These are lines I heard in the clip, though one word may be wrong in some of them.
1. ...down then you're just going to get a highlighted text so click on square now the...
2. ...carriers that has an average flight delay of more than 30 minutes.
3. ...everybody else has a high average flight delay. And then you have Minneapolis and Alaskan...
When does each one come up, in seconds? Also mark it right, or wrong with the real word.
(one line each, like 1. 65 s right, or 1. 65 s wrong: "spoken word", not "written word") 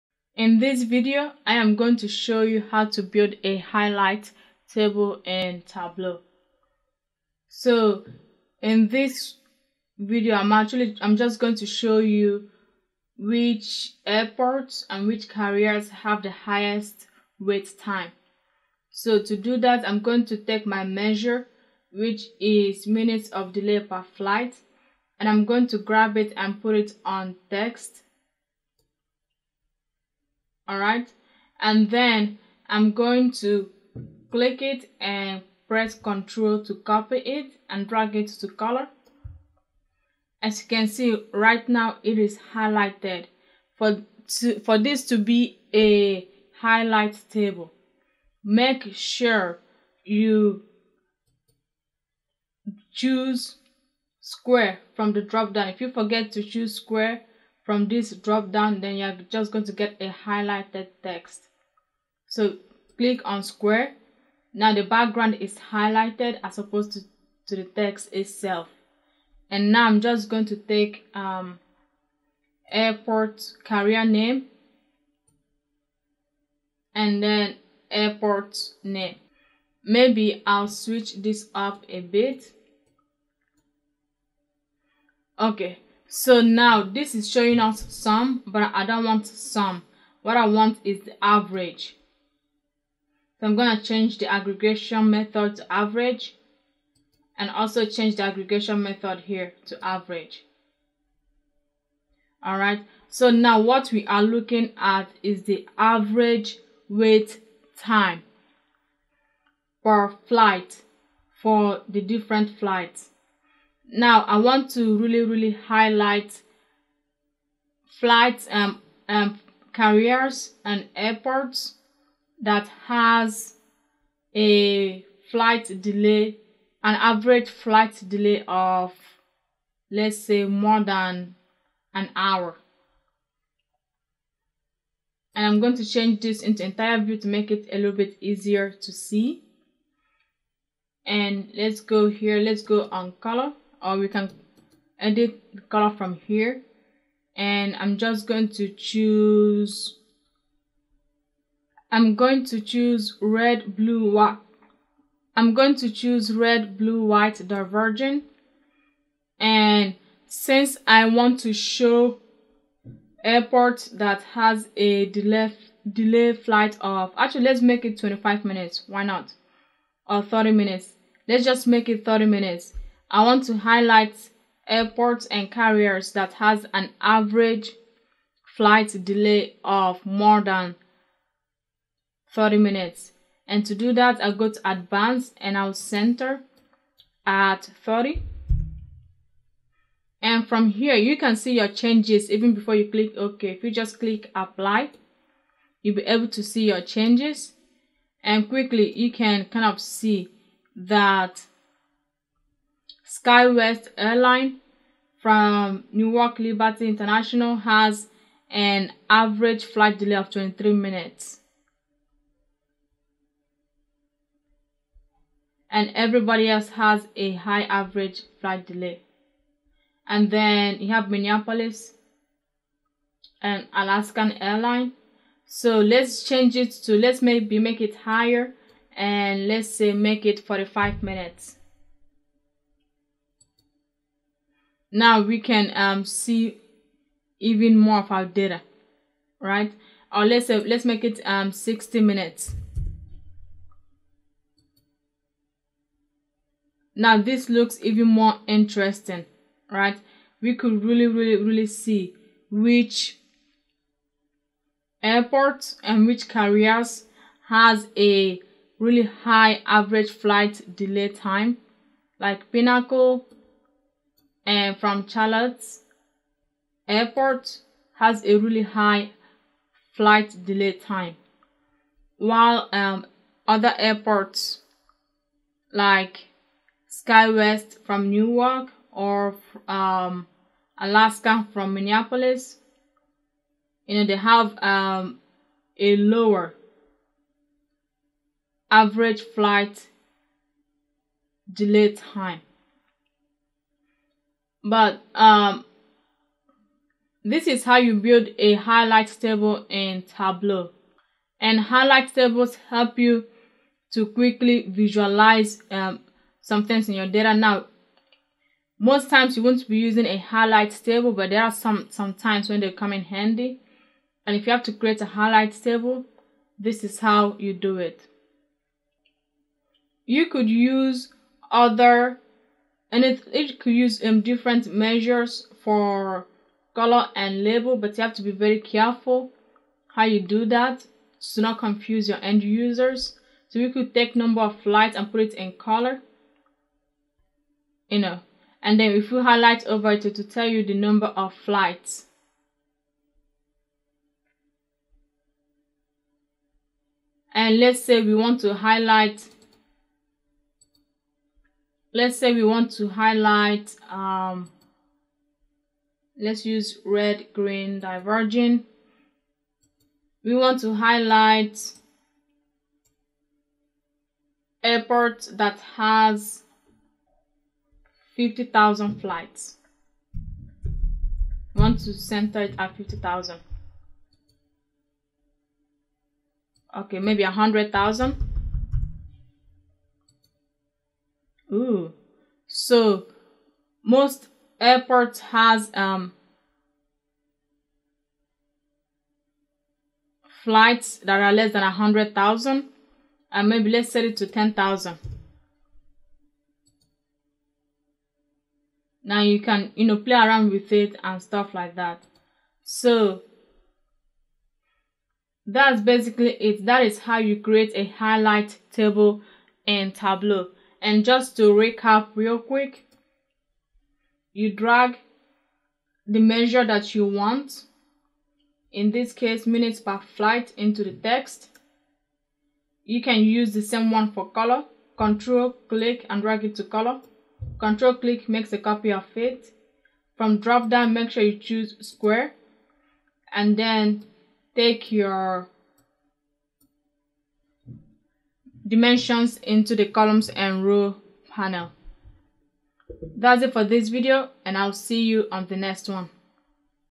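1. 58 s right
2. 175 s right
3. 215 s right.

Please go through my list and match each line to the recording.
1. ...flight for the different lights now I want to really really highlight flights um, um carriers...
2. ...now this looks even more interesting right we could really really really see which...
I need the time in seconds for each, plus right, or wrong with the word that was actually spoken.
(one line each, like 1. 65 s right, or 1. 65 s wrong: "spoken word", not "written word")
1. 110 s wrong: "flights", not "lights"
2. 246 s right.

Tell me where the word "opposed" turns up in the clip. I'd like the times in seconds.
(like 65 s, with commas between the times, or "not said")
66 s.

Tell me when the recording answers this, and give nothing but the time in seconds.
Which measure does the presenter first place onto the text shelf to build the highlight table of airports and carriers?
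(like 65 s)
22 s.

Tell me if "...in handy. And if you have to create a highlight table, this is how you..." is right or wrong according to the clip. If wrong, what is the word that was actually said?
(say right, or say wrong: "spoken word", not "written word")
right.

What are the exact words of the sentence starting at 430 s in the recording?
From drop down make sure you choose square and then take your dimensions into the columns and row panel.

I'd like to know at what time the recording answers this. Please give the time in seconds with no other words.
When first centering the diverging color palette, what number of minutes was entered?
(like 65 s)
185 s.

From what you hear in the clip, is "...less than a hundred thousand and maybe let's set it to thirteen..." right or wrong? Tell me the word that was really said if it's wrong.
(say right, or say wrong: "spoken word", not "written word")
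wrong: "ten", not "thirteen".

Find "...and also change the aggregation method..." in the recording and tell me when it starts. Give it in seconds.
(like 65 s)
97 s.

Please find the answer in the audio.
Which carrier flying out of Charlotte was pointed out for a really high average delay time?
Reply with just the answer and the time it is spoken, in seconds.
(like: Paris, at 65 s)
Pinnacle, at 262 s.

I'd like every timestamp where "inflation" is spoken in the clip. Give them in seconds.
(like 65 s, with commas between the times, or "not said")
not said.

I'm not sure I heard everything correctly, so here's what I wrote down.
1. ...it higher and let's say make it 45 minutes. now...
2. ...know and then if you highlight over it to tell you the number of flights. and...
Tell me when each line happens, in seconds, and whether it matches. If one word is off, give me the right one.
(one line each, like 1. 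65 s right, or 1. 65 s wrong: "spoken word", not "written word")
1. 227 s right
2. 337 s right.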